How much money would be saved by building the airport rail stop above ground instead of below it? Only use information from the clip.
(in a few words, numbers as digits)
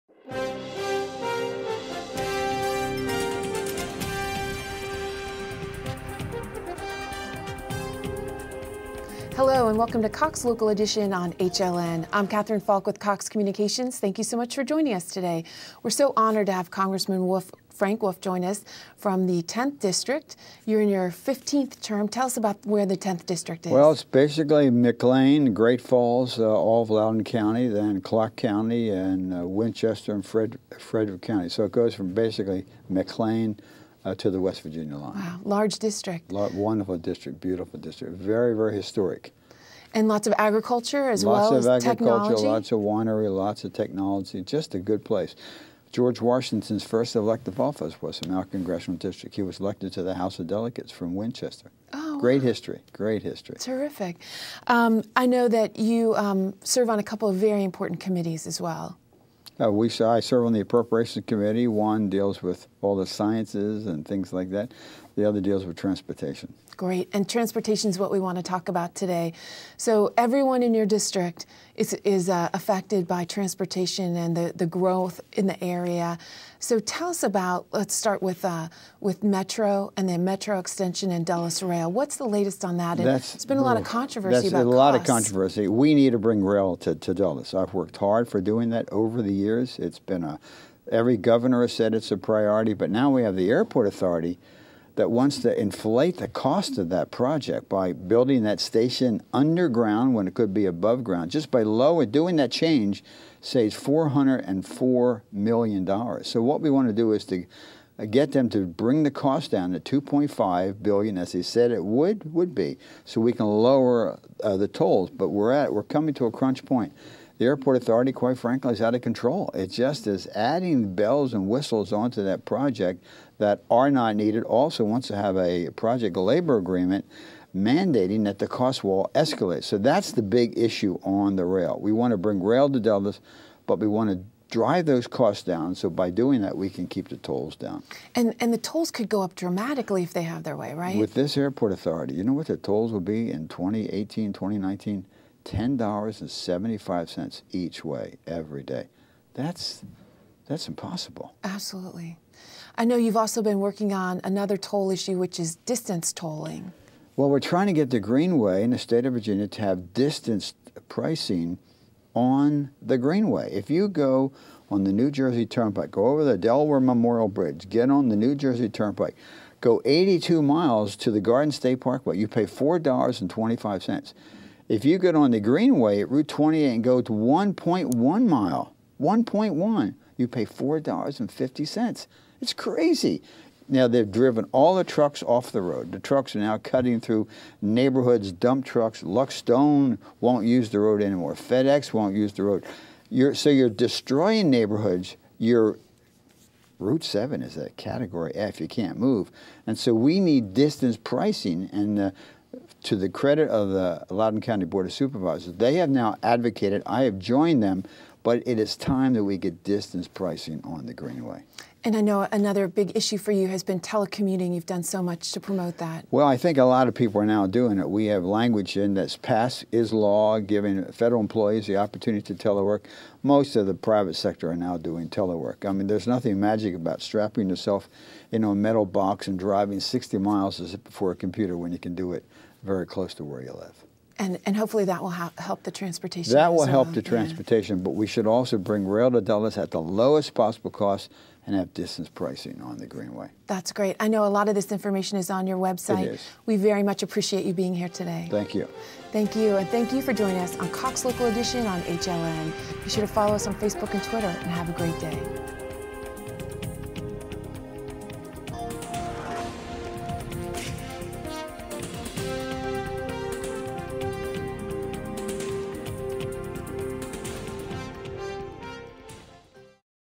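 $404 million.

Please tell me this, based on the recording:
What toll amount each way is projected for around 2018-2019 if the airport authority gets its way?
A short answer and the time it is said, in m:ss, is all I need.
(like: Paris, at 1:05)
$10.75, at 2:25.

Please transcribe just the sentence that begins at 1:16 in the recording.
So tell us about, let's start with, uh, with Metro and then Metro Extension and Dulles Rail.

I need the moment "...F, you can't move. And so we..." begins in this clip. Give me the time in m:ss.
3:18.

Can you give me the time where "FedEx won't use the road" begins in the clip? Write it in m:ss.
3:11.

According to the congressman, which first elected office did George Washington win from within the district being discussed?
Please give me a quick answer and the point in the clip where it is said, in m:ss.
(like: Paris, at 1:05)
House of Delegates, at 0:50.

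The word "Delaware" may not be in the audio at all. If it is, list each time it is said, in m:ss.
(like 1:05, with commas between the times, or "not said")
2:46.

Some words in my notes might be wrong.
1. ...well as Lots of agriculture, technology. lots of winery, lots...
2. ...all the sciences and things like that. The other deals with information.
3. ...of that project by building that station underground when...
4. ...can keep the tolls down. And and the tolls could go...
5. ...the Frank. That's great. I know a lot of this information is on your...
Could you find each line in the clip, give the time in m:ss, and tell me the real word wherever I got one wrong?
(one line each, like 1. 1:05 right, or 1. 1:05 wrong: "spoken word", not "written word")
1. 0:41 right
2. 1:02 wrong: "transportation", not "information"
3. 1:36 right
4. 2:16 right
5. 4:02 wrong: "Greenway", not "Frank".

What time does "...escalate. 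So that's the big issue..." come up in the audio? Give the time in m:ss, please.
2:09.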